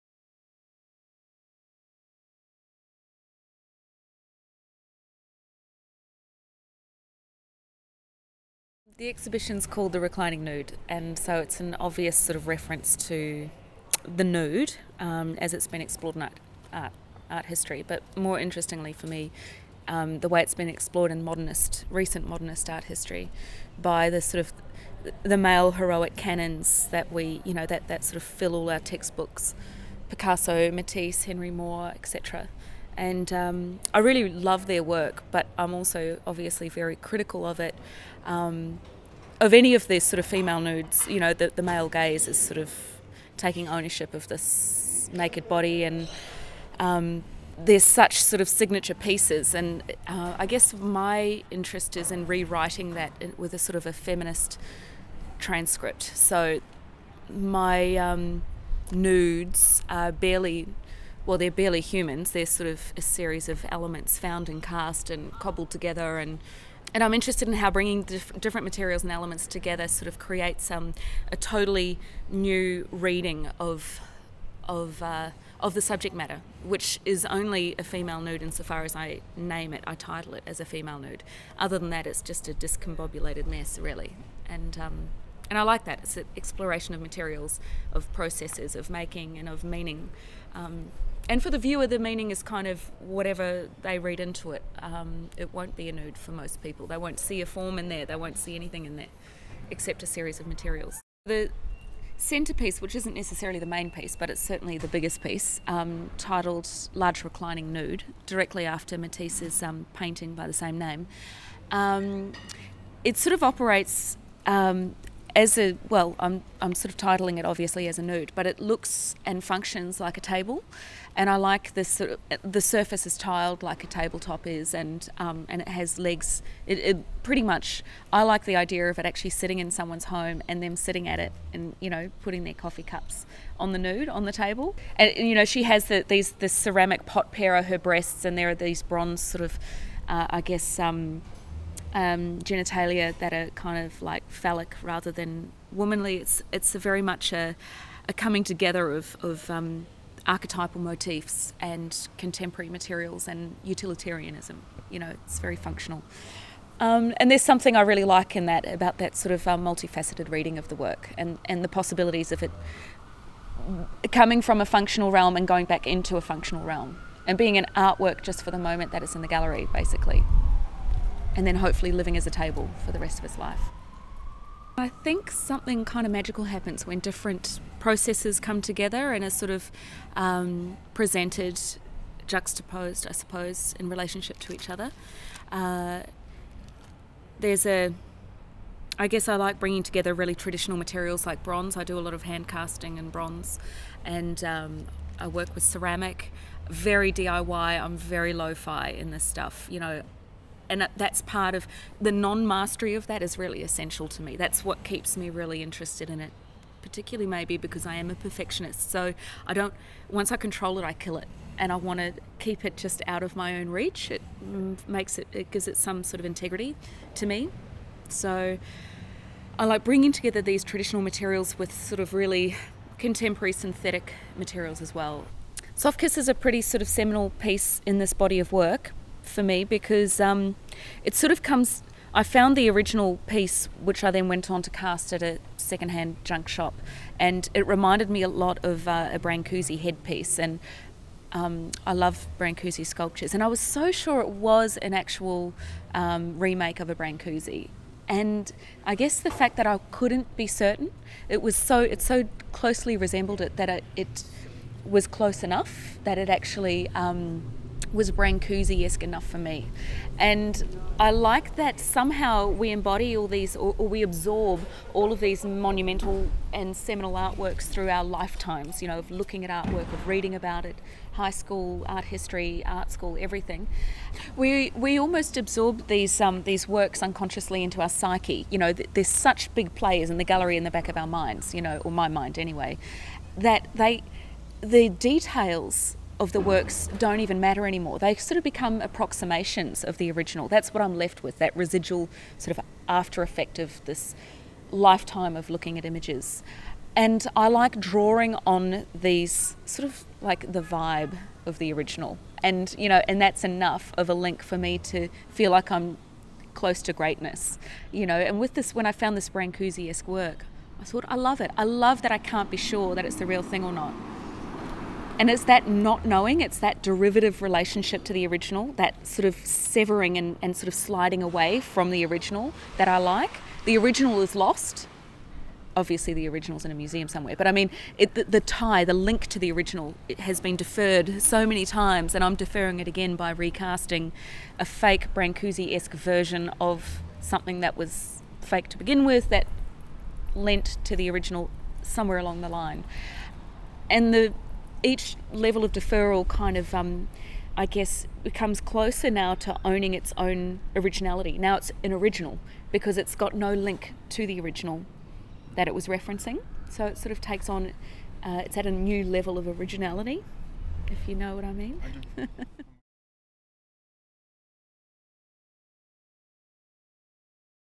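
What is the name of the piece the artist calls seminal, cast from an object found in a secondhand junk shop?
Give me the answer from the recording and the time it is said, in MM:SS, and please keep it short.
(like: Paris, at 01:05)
Soft Kiss, at 03:45.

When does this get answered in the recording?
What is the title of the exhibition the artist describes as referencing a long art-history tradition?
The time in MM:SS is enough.
00:09.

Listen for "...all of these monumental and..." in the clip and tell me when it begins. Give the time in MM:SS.
04:24.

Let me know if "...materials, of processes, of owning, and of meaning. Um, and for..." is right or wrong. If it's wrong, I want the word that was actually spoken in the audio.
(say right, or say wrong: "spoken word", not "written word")
wrong: "making", not "owning".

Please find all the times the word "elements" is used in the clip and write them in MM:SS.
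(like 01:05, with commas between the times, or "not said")
01:03, 01:09.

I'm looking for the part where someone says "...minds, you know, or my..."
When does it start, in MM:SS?
04:41.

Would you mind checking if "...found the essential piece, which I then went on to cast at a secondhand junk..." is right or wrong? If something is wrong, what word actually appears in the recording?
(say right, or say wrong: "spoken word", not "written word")
wrong: "original", not "essential".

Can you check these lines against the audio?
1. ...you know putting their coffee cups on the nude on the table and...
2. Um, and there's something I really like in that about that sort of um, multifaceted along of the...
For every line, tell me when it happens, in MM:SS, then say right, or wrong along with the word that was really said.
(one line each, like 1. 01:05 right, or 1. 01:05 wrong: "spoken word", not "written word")
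1. 02:11 right
2. 02:36 wrong: "reading", not "along".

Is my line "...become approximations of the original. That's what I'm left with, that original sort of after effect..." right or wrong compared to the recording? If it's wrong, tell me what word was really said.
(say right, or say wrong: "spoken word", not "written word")
wrong: "residual", not "original".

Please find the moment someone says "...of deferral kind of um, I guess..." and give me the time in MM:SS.
05:45.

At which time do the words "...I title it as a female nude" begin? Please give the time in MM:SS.
01:19.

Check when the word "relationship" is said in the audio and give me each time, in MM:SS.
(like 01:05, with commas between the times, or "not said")
03:03, 05:17.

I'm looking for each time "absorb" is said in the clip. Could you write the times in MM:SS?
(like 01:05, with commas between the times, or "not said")
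04:24, 04:35.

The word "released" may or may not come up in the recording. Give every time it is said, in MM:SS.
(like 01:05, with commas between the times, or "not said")
not said.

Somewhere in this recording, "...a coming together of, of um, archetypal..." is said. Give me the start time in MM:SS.
02:28.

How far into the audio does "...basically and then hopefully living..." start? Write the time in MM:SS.
02:49.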